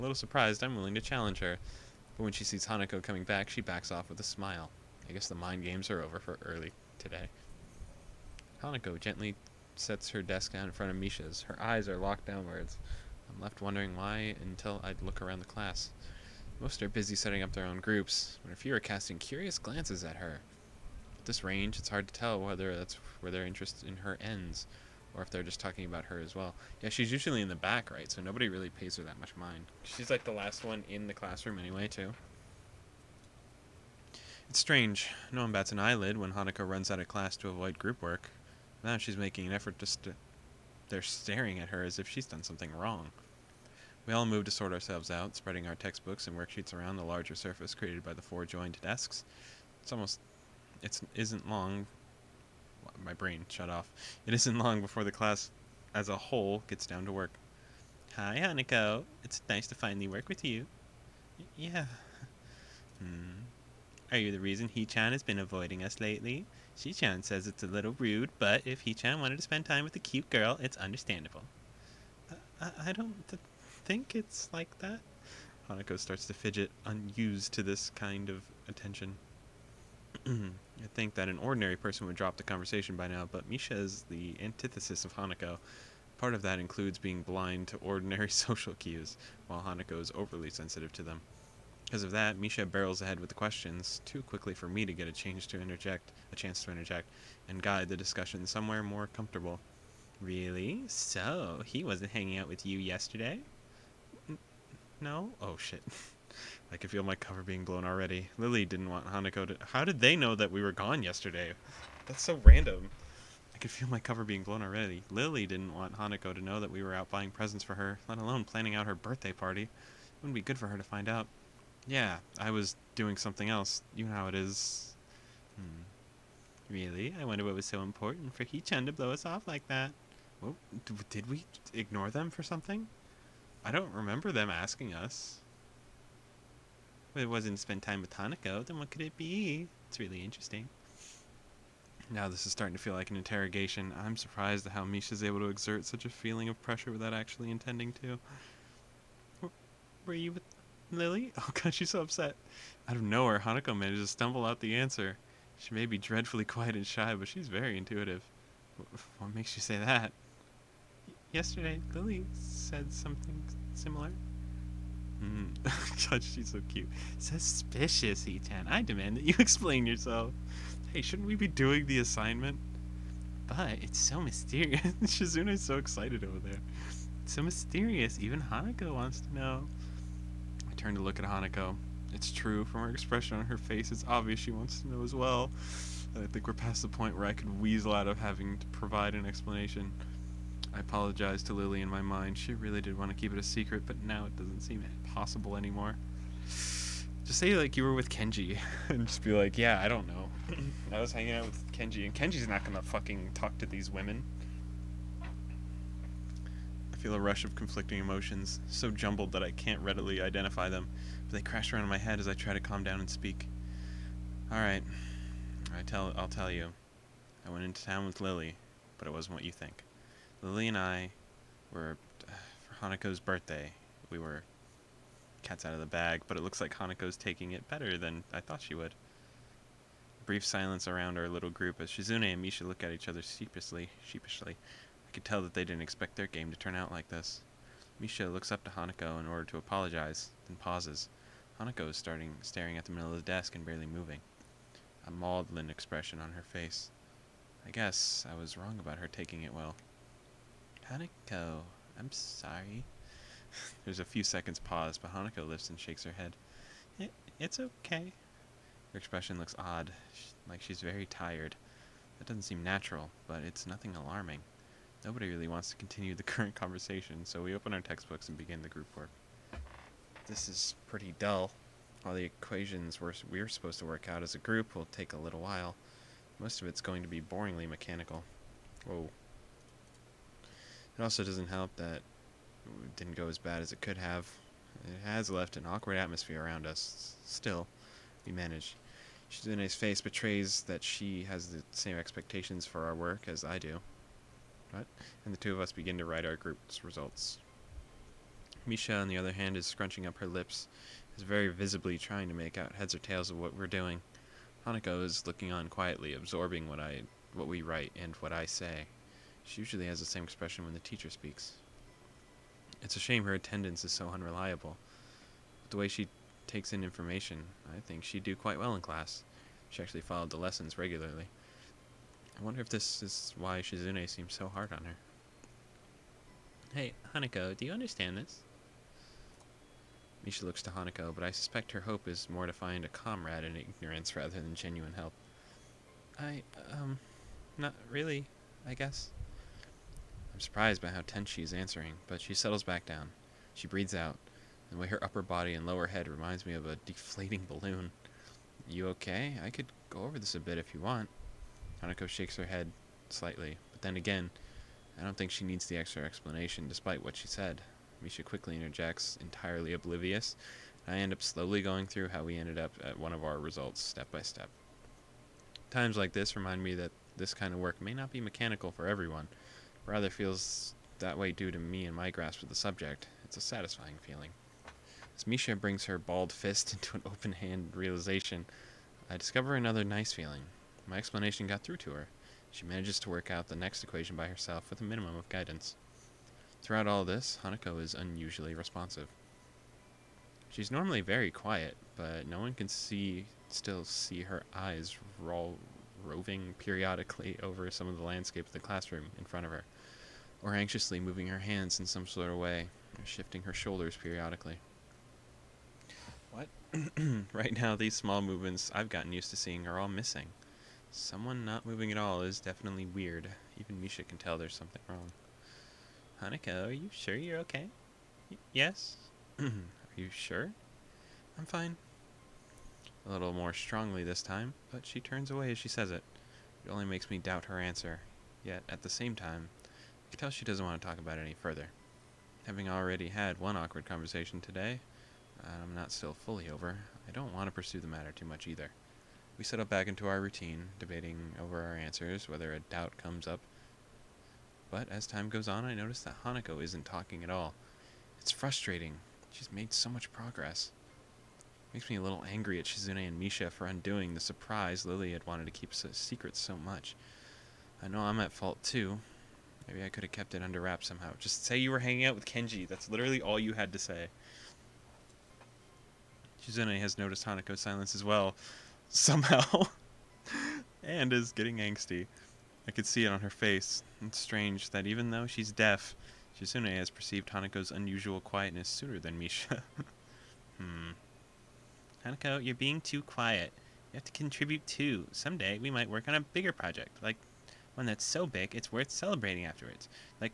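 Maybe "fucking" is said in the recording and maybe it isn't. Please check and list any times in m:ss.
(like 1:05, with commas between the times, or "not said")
3:22.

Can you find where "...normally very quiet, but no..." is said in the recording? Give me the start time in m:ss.
6:30.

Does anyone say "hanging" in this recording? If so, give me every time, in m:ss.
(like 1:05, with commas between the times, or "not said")
1:42, 3:21, 7:41.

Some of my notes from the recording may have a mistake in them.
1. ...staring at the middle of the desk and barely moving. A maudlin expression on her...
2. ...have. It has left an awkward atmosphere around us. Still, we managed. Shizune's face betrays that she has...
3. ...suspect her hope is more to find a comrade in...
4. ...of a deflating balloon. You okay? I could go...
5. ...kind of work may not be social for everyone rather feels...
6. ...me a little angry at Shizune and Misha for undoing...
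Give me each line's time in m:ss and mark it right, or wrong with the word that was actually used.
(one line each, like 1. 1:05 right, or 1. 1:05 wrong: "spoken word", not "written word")
1. 4:02 right
2. 4:43 right
3. 5:31 right
4. 5:46 right
5. 6:07 wrong: "mechanical", not "social"
6. 7:31 right.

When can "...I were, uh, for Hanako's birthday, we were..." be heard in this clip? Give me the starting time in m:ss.
3:40.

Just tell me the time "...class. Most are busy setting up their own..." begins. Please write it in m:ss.
0:15.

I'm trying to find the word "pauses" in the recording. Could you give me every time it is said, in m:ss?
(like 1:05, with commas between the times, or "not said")
4:00, 4:14.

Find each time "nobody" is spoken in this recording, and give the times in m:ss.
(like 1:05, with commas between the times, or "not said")
0:28, 4:25.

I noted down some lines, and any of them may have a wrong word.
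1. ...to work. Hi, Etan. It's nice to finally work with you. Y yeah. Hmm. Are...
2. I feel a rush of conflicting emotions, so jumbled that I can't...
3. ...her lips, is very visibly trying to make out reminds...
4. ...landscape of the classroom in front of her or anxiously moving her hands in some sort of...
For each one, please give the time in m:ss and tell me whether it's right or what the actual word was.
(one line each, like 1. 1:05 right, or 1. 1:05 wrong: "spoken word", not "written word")
1. 0:57 wrong: "Hanako", not "Etan"
2. 3:25 right
3. 5:00 wrong: "heads", not "reminds"
4. 6:38 right.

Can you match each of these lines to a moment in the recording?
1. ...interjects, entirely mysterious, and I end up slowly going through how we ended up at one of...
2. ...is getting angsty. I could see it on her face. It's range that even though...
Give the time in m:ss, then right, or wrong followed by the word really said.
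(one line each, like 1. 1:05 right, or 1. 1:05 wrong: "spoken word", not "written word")
1. 5:58 wrong: "oblivious", not "mysterious"
2. 7:51 wrong: "strange", not "range".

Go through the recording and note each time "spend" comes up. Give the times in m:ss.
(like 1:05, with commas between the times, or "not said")
1:09, 2:17.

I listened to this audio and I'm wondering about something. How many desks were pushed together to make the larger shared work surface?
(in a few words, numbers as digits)
4.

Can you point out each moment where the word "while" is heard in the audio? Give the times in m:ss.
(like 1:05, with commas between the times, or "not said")
1:29, 4:35.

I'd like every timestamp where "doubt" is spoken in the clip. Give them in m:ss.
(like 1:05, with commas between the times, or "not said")
7:07, 7:22.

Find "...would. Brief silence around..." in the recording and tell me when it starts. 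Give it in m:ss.
3:48.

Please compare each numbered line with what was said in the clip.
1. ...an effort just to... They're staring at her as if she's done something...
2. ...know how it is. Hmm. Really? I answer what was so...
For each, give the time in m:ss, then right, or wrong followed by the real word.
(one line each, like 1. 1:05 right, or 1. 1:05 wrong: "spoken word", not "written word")
1. 0:39 right
2. 2:04 wrong: "wonder", not "answer".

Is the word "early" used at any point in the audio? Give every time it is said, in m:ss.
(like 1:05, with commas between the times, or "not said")
0:06.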